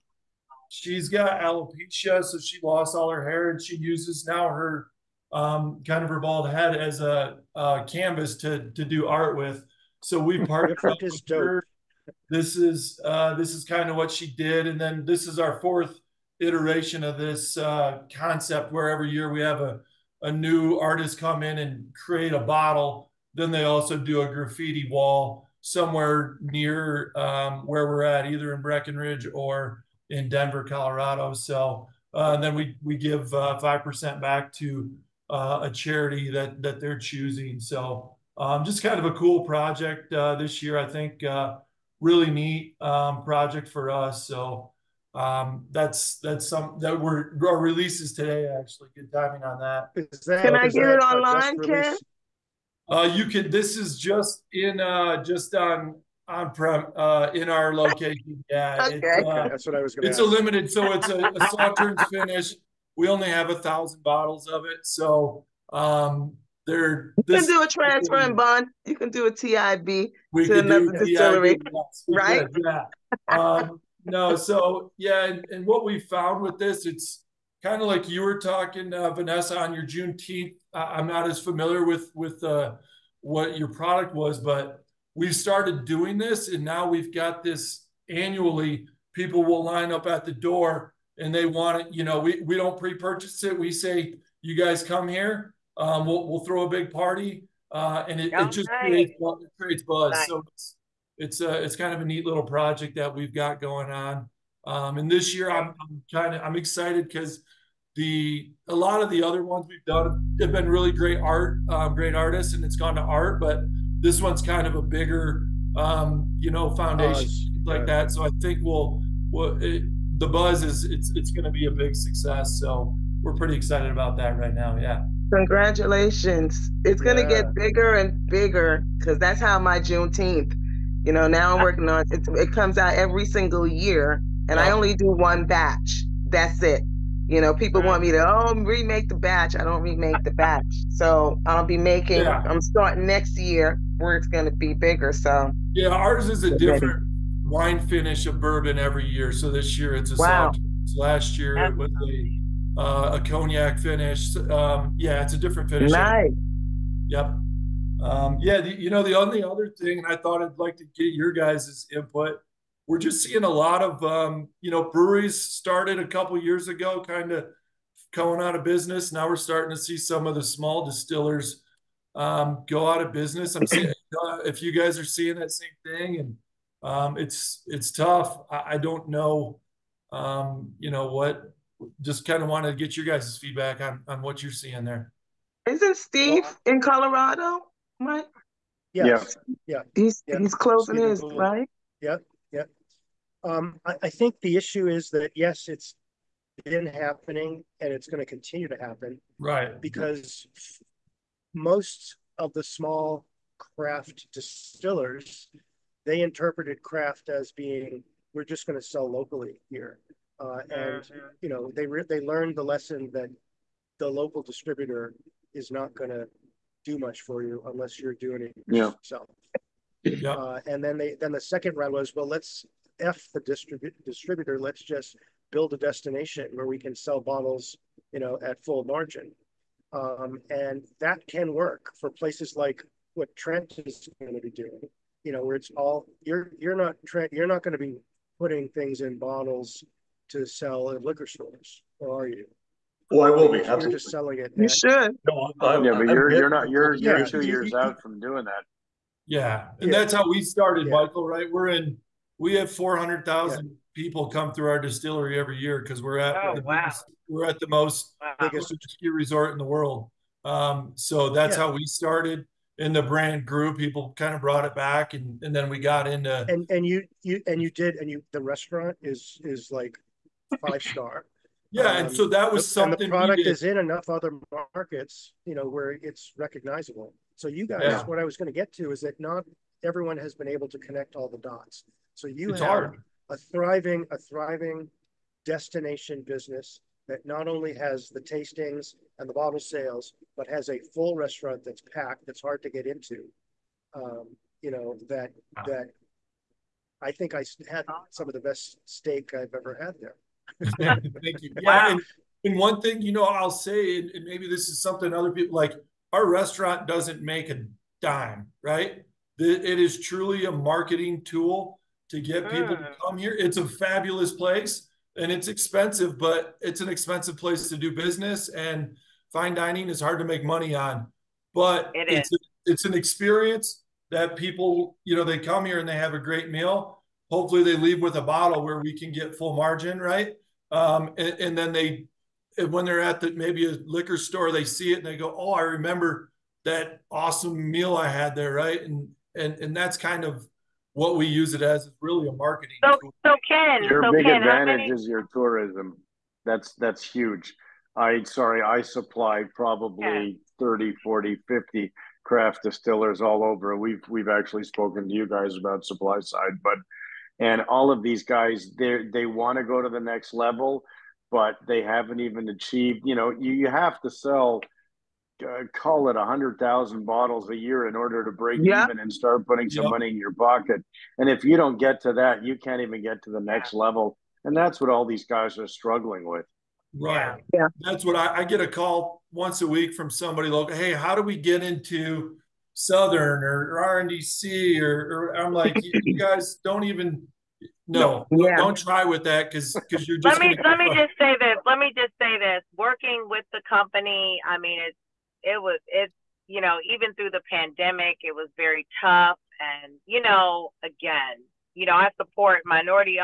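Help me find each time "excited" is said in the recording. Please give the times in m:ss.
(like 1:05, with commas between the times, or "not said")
1:46, 2:03.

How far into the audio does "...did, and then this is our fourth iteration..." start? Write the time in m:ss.
0:14.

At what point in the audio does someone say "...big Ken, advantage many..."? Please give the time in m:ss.
5:44.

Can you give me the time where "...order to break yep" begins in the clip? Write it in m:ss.
6:07.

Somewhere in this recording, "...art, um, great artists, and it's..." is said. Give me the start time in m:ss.
1:51.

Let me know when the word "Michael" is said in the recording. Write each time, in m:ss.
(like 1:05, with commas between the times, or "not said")
4:10.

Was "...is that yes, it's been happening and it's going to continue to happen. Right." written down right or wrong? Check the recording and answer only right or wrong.
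right.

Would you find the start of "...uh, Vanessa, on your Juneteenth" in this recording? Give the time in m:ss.
1:18.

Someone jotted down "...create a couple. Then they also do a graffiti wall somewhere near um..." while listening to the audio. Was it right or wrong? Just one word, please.
wrong.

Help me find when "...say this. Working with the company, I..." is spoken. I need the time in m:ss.
6:32.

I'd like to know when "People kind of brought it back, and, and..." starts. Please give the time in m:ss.
4:23.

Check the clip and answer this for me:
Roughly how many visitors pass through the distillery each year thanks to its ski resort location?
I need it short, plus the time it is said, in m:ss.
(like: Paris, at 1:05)
400,000, at 4:12.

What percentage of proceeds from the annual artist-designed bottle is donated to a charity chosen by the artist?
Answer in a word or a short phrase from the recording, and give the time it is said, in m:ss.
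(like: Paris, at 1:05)
5%, at 0:33.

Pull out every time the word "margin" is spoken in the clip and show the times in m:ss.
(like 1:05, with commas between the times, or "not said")
3:48, 5:29.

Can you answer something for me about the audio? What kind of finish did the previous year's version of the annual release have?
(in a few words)
Cognac finish.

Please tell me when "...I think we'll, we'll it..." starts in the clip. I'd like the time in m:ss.
1:58.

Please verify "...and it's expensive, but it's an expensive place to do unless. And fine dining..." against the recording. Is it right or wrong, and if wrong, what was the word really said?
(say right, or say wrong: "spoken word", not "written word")
wrong: "business", not "unless".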